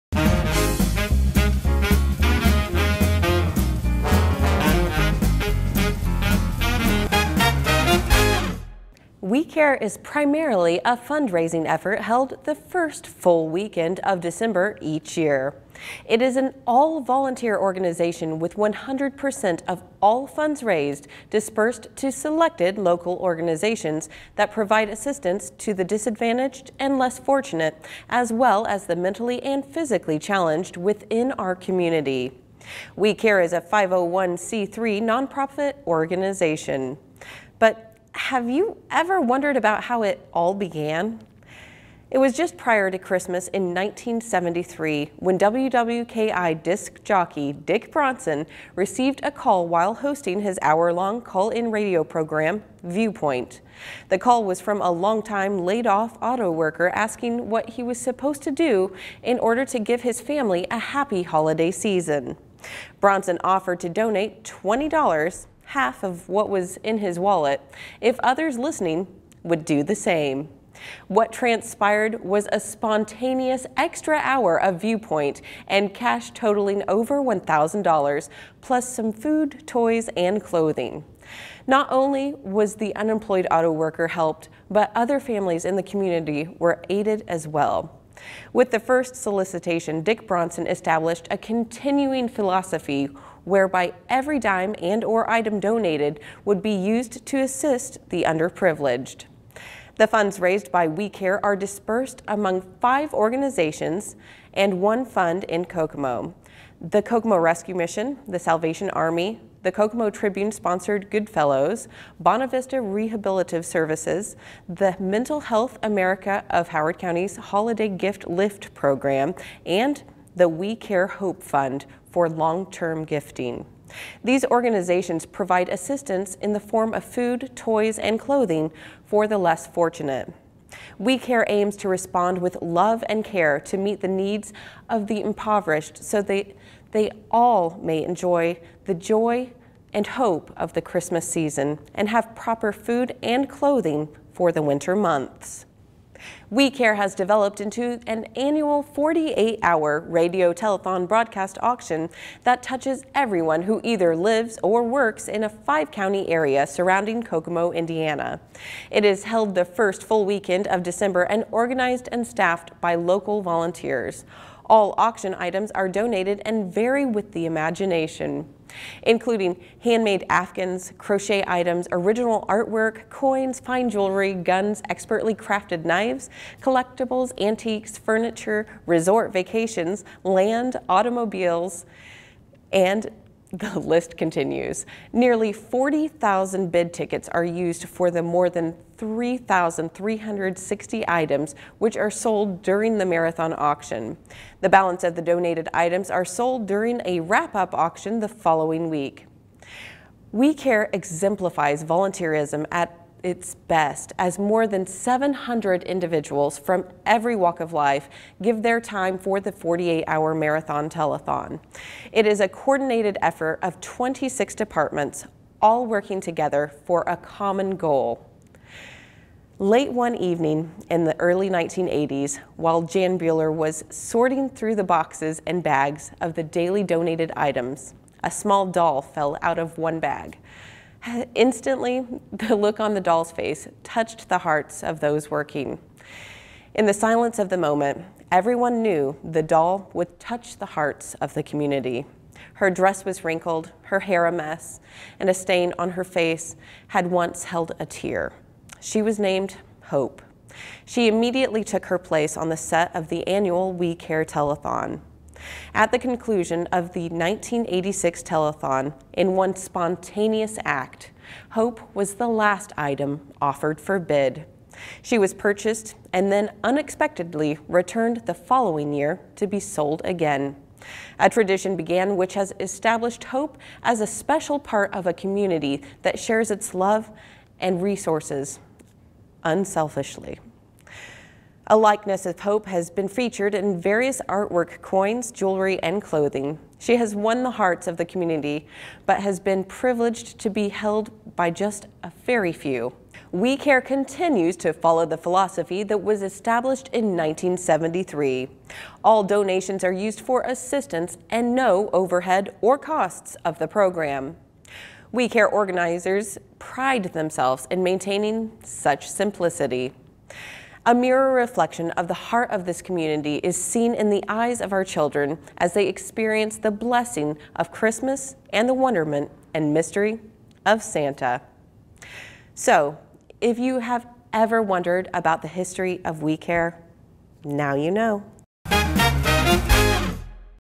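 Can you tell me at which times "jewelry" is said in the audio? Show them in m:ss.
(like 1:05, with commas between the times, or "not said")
2:53, 4:45.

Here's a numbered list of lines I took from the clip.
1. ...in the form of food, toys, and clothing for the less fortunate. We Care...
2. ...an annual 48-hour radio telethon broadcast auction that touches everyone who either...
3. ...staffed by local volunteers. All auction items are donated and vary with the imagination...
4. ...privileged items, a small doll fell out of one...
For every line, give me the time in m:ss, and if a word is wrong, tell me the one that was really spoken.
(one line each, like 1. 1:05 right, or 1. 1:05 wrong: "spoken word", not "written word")
1. 2:06 right
2. 2:28 right
3. 2:42 right
4. 3:46 wrong: "donated", not "privileged".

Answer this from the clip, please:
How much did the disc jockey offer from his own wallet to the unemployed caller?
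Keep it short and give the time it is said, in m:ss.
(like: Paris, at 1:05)
$20, at 1:04.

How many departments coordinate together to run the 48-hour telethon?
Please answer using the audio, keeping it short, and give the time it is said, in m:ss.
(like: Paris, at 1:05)
26, at 3:33.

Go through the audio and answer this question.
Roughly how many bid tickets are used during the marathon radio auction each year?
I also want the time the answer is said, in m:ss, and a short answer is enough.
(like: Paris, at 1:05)
40,000, at 3:05.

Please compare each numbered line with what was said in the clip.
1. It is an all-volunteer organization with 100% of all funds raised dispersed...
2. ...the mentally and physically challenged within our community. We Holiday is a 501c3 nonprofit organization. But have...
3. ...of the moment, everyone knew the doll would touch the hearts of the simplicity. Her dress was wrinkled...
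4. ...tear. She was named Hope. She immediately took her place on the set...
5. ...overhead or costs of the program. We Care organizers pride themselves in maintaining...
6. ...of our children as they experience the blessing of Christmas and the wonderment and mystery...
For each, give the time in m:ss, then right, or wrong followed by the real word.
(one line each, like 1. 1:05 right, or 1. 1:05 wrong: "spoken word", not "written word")
1. 0:16 right
2. 0:28 wrong: "Care", not "Holiday"
3. 3:57 wrong: "community", not "simplicity"
4. 4:07 right
5. 5:01 right
6. 5:14 right.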